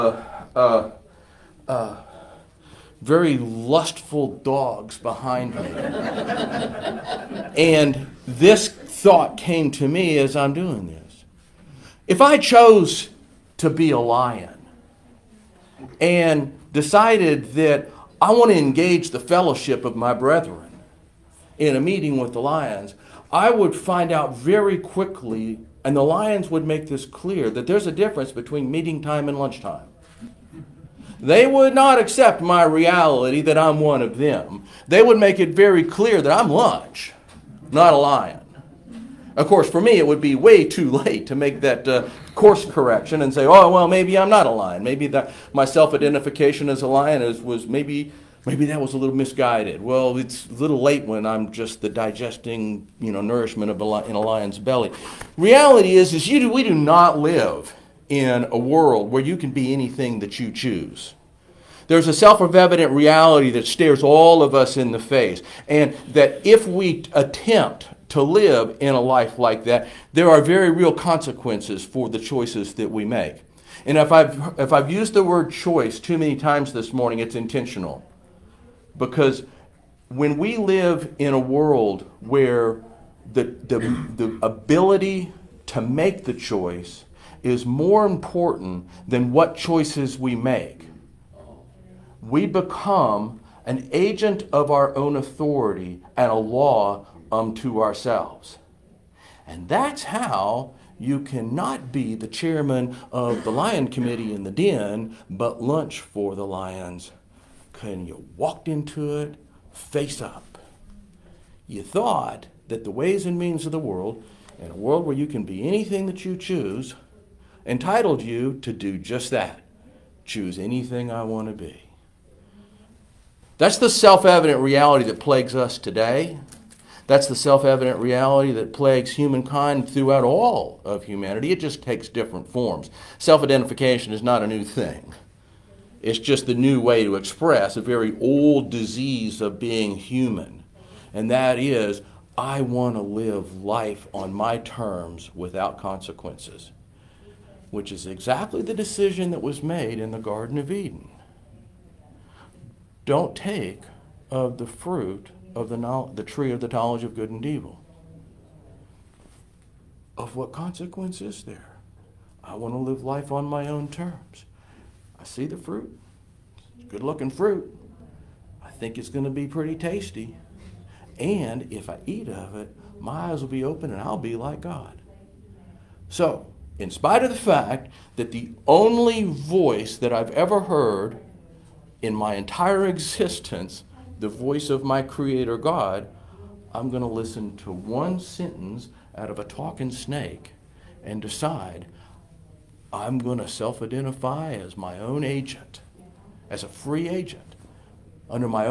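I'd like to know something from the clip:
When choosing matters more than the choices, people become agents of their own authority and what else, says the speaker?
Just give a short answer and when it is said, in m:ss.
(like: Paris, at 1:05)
A law unto ourselves, at 1:36.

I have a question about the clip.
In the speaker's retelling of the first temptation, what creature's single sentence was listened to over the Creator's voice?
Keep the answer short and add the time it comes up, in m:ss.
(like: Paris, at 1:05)
A talking snake, at 3:09.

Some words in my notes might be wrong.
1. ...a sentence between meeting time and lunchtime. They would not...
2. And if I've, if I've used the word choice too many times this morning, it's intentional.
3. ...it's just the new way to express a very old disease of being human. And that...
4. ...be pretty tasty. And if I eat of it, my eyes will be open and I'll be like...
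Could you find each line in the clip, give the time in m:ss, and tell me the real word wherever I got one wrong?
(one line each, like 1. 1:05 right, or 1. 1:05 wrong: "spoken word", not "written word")
1. 0:27 wrong: "difference", not "sentence"
2. 1:13 right
3. 2:16 right
4. 2:49 right.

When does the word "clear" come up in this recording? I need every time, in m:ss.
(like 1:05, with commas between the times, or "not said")
0:27, 0:35.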